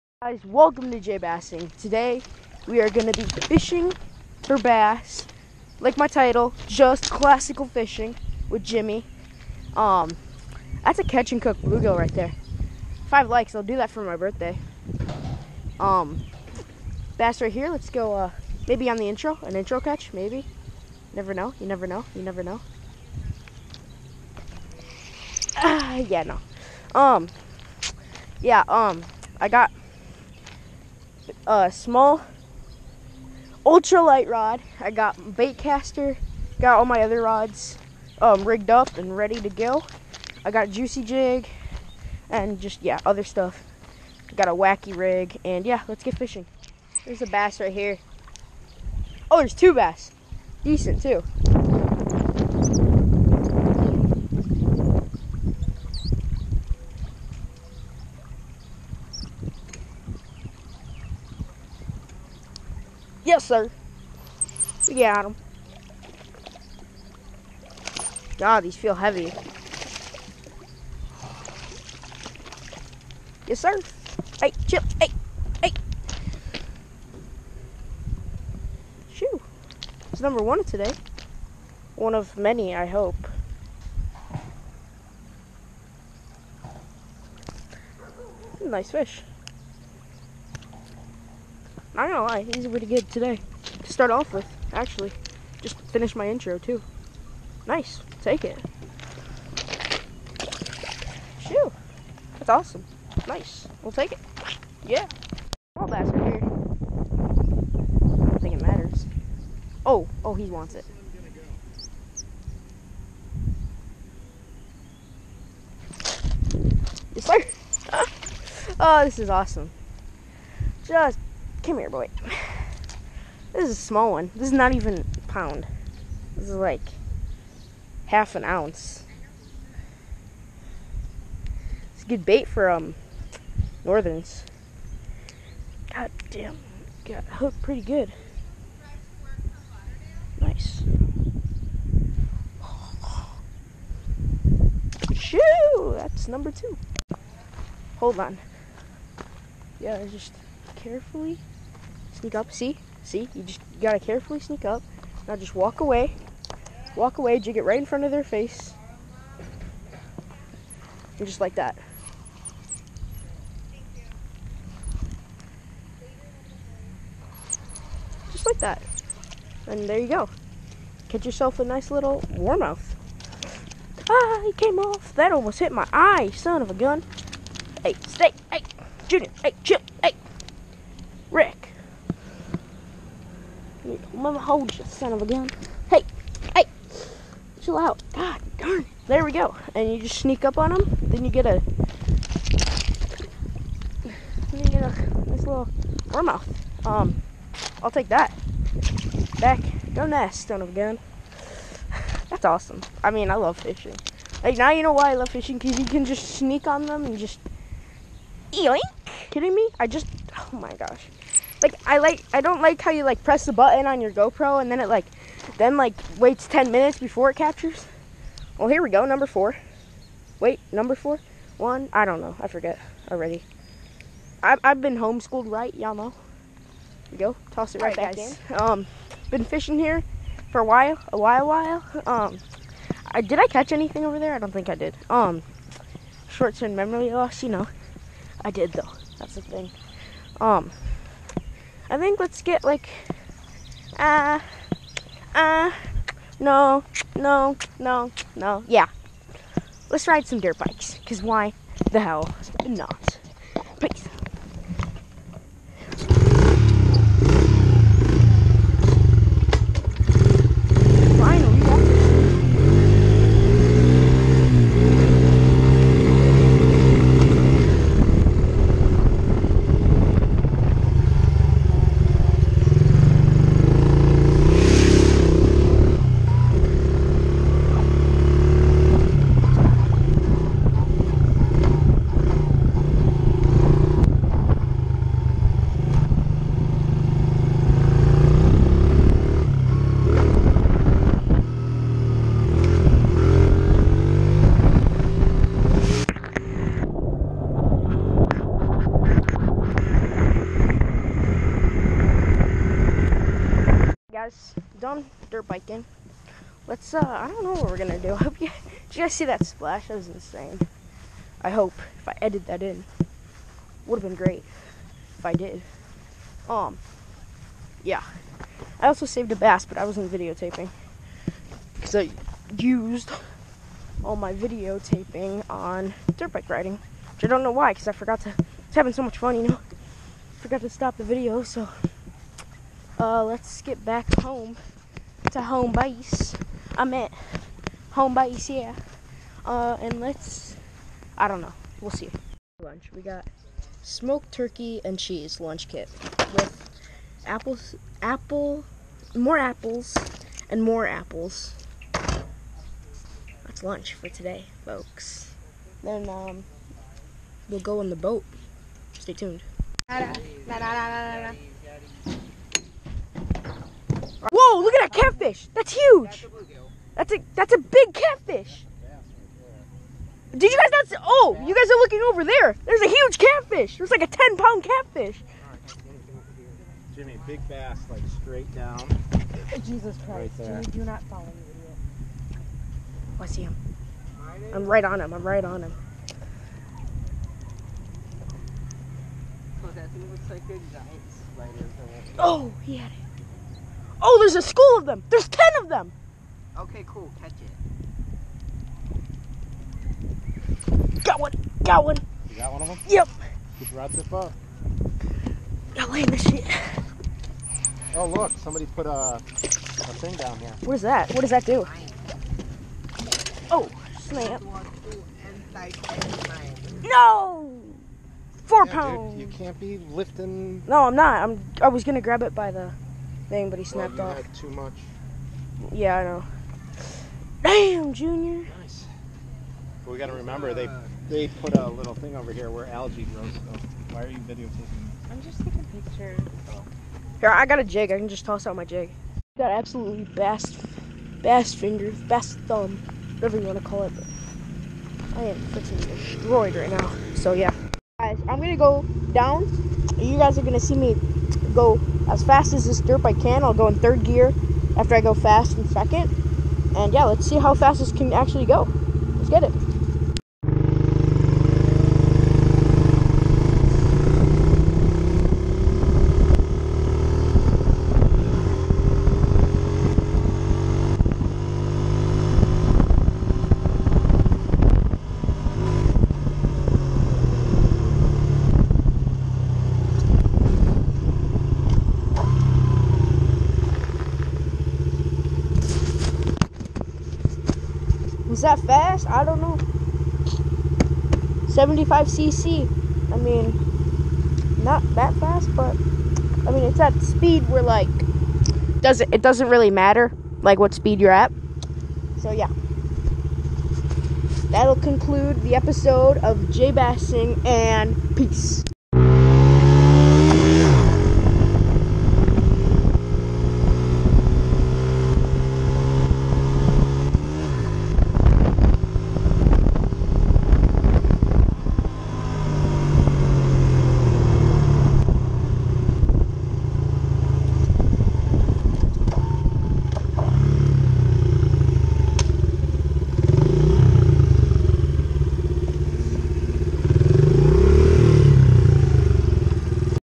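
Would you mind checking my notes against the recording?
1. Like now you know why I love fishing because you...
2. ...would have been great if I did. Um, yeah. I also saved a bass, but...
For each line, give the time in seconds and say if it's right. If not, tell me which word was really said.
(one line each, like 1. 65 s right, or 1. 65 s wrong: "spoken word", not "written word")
1. 204 s right
2. 313 s right.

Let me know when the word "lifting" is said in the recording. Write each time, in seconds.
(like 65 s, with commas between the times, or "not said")
419 s.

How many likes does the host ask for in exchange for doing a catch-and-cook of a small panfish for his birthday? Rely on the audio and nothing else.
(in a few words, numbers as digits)
5.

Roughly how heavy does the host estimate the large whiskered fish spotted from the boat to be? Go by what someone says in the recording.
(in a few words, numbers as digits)
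10 pounds.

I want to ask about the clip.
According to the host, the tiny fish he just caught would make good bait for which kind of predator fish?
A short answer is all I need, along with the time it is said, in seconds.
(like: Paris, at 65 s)
Northerns, at 133 s.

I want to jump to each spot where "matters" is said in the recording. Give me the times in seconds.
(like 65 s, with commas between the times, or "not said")
108 s, 499 s.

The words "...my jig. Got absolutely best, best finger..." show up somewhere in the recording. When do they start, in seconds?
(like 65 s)
438 s.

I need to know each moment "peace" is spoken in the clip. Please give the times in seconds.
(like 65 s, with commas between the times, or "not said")
253 s, 508 s.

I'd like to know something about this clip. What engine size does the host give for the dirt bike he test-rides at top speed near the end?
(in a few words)
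75 cc.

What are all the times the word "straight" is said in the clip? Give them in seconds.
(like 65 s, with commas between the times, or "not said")
378 s.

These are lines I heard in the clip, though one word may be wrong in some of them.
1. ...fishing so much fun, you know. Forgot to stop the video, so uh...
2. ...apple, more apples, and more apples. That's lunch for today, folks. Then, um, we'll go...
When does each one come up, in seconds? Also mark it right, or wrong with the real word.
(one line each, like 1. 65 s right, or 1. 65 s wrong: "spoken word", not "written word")
1. 328 s wrong: "having", not "fishing"
2. 348 s right.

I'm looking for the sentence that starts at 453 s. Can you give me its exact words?
I'll go in third gear after I go fast in second.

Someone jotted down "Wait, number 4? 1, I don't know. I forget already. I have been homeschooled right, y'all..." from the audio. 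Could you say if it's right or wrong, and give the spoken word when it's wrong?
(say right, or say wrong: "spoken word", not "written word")
right.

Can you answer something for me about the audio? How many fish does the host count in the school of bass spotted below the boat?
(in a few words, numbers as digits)
10.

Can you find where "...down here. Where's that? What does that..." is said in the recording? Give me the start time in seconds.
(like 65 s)
410 s.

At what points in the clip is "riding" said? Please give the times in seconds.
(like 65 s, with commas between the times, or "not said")
326 s.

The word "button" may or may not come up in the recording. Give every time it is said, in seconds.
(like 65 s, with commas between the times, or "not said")
213 s.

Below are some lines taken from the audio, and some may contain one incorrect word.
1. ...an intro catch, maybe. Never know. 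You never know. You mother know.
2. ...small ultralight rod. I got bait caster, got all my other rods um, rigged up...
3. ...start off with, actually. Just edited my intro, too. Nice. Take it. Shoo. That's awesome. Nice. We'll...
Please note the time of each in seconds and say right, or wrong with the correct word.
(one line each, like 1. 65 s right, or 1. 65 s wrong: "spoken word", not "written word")
1. 19 s wrong: "never", not "mother"
2. 31 s right
3. 93 s wrong: "finished", not "edited".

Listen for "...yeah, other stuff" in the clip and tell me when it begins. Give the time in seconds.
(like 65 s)
42 s.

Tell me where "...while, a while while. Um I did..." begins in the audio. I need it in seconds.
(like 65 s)
230 s.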